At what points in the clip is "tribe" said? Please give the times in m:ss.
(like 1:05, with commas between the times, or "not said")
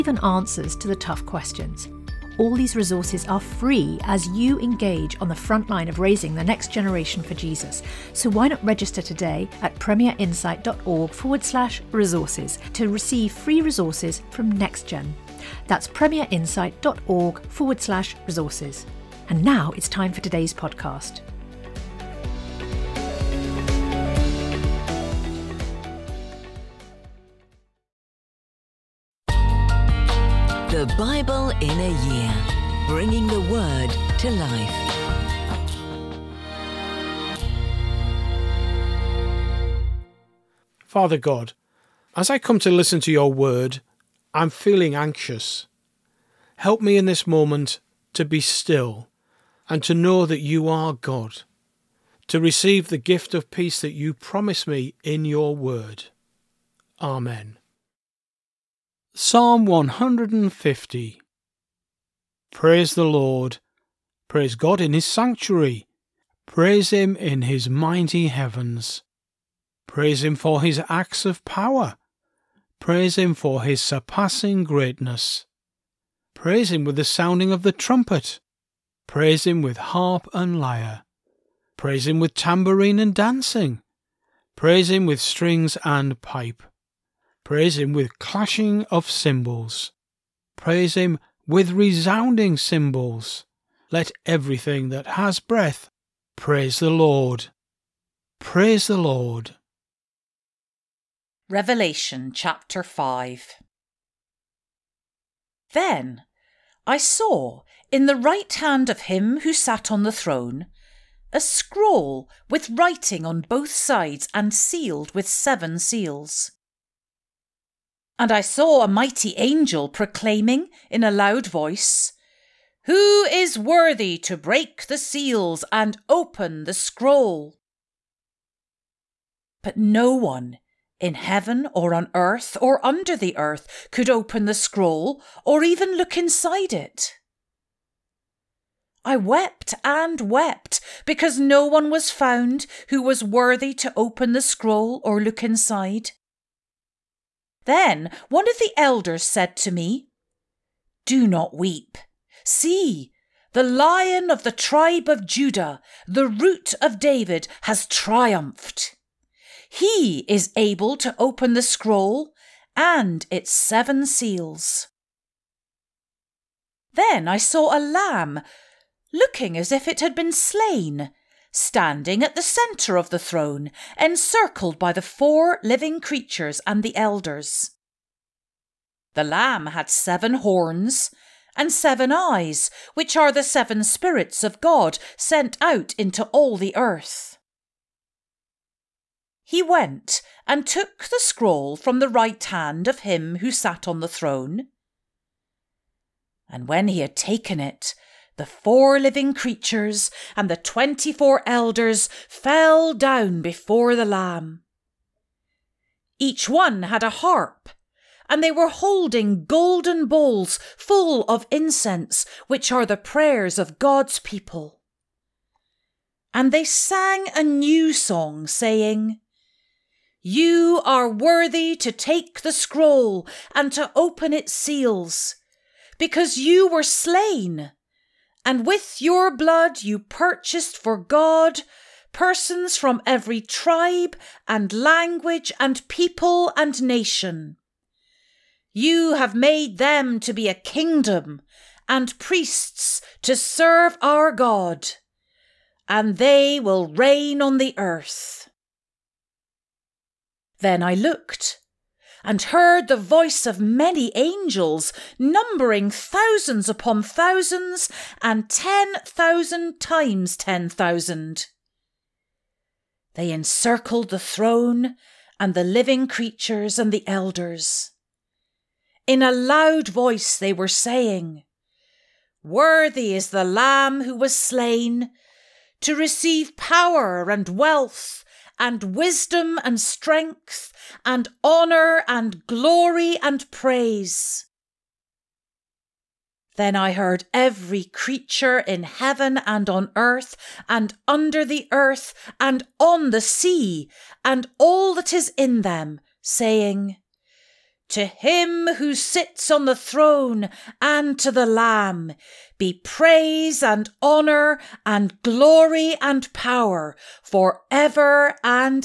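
2:34, 3:53.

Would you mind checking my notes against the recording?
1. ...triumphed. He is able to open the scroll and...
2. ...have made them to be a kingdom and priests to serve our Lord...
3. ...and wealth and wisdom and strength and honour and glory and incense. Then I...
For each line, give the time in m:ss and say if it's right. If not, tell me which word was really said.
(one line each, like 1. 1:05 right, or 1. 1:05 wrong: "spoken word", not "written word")
1. 2:37 right
2. 3:59 wrong: "God", not "Lord"
3. 4:37 wrong: "praise", not "incense".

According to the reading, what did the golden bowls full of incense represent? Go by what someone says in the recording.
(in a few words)
The prayers of God's people.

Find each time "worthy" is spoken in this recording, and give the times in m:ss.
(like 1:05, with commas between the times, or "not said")
2:03, 2:23, 3:41, 4:32.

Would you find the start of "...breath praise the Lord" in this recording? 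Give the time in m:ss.
1:35.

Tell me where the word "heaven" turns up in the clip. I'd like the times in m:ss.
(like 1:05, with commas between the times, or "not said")
1:08, 2:11, 4:48.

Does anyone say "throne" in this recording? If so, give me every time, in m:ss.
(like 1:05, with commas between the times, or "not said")
1:50, 2:53, 3:14, 4:24, 4:59.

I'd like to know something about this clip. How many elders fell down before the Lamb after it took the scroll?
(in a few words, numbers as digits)
24.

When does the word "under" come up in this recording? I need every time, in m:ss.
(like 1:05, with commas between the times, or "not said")
2:12, 4:51.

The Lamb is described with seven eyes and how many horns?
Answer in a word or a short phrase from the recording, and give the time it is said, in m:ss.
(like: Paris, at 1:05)
7, at 2:59.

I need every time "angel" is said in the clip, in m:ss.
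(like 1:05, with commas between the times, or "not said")
1:59, 4:14.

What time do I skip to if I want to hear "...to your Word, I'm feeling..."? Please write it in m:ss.
0:42.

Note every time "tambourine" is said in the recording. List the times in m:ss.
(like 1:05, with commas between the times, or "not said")
1:22.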